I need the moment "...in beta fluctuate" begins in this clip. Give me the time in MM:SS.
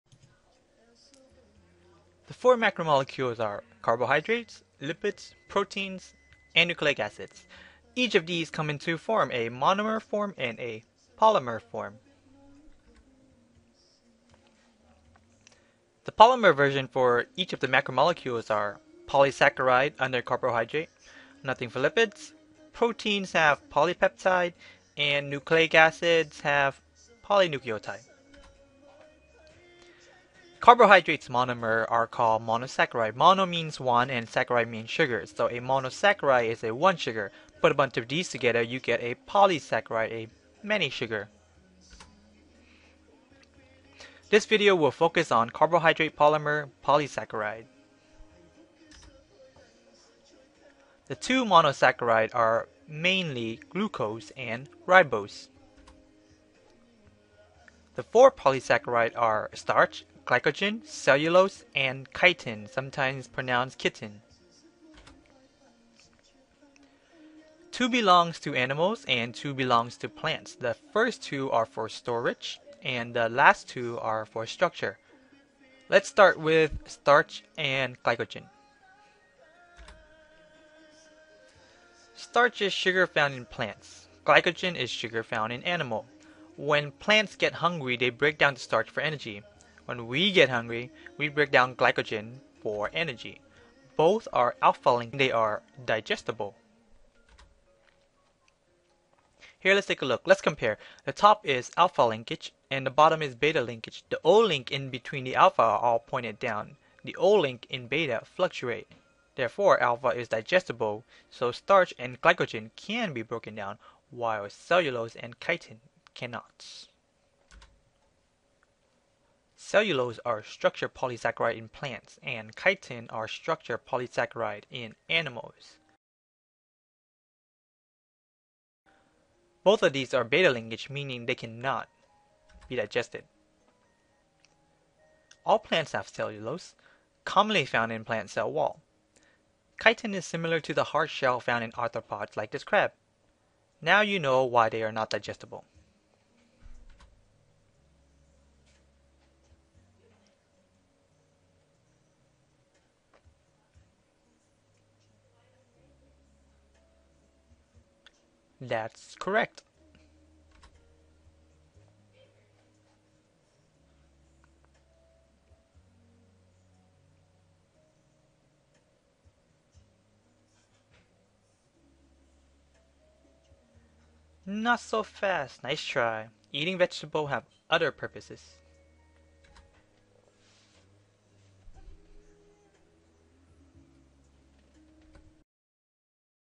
01:47.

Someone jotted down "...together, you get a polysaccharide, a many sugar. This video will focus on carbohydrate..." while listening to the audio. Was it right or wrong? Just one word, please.
right.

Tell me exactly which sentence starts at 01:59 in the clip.
Cellulose are structure polysaccharide in plants, and chitin are structure polysaccharide in animals.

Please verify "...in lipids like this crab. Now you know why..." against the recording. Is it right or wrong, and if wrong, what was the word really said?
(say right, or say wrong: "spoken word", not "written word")
wrong: "arthropods", not "lipids".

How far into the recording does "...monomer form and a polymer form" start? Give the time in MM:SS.
00:09.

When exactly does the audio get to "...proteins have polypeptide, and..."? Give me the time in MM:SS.
00:22.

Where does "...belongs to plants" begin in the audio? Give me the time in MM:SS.
01:09.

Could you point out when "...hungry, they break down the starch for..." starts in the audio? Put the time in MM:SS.
01:27.